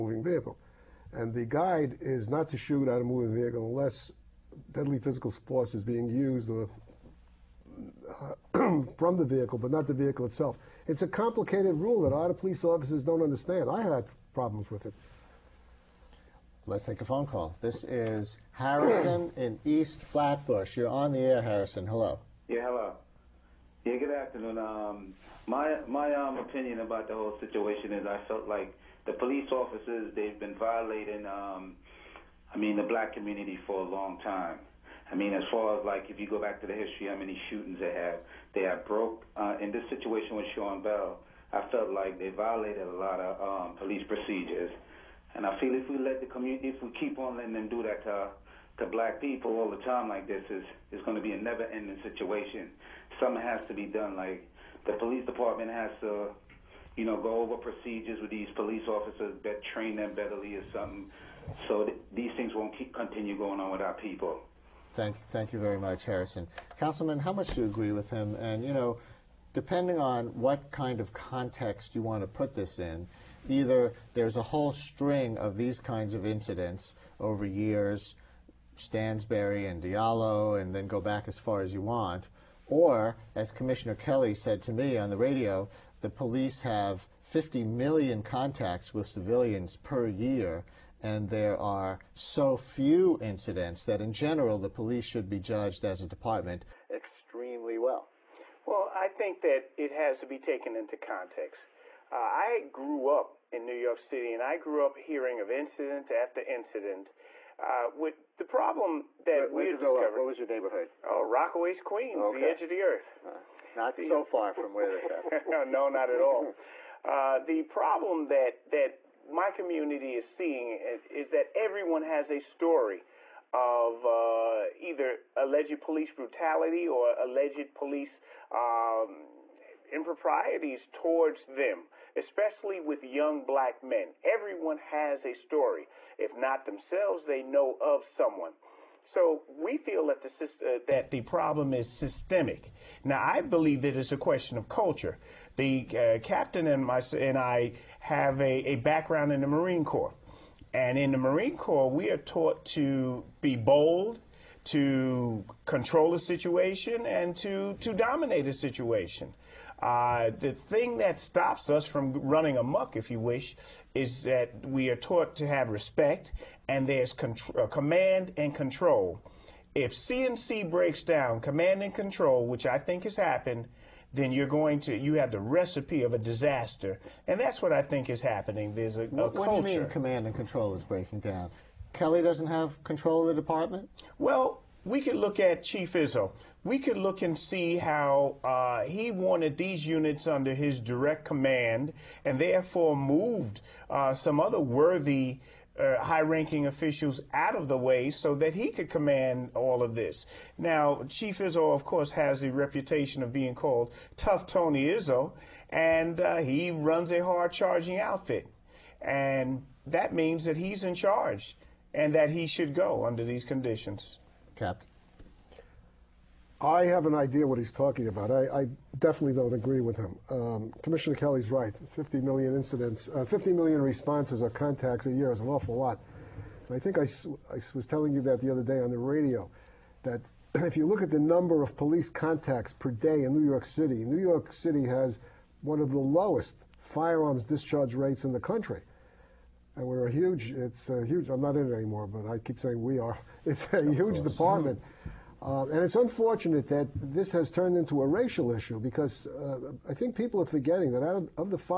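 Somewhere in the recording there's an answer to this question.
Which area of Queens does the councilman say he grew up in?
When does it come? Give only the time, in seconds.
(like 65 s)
111 s.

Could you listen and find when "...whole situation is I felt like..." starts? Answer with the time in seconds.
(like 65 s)
27 s.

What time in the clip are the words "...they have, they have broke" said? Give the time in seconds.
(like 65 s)
37 s.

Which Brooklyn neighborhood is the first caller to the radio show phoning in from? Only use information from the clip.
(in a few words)
East Flatbush.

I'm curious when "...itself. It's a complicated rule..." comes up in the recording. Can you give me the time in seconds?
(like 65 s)
10 s.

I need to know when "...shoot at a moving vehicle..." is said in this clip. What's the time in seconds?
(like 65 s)
2 s.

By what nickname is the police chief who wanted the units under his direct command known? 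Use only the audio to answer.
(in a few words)
Tough Tony Izzo.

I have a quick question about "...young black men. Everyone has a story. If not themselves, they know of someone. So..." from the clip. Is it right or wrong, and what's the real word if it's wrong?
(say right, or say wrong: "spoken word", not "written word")
right.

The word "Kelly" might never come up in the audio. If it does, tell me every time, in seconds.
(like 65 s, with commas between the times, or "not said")
83 s, 181 s, 221 s.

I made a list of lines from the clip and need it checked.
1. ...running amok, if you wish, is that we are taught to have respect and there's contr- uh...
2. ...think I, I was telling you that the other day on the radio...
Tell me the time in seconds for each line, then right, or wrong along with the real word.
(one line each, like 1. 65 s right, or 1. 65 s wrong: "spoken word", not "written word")
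1. 162 s right
2. 226 s right.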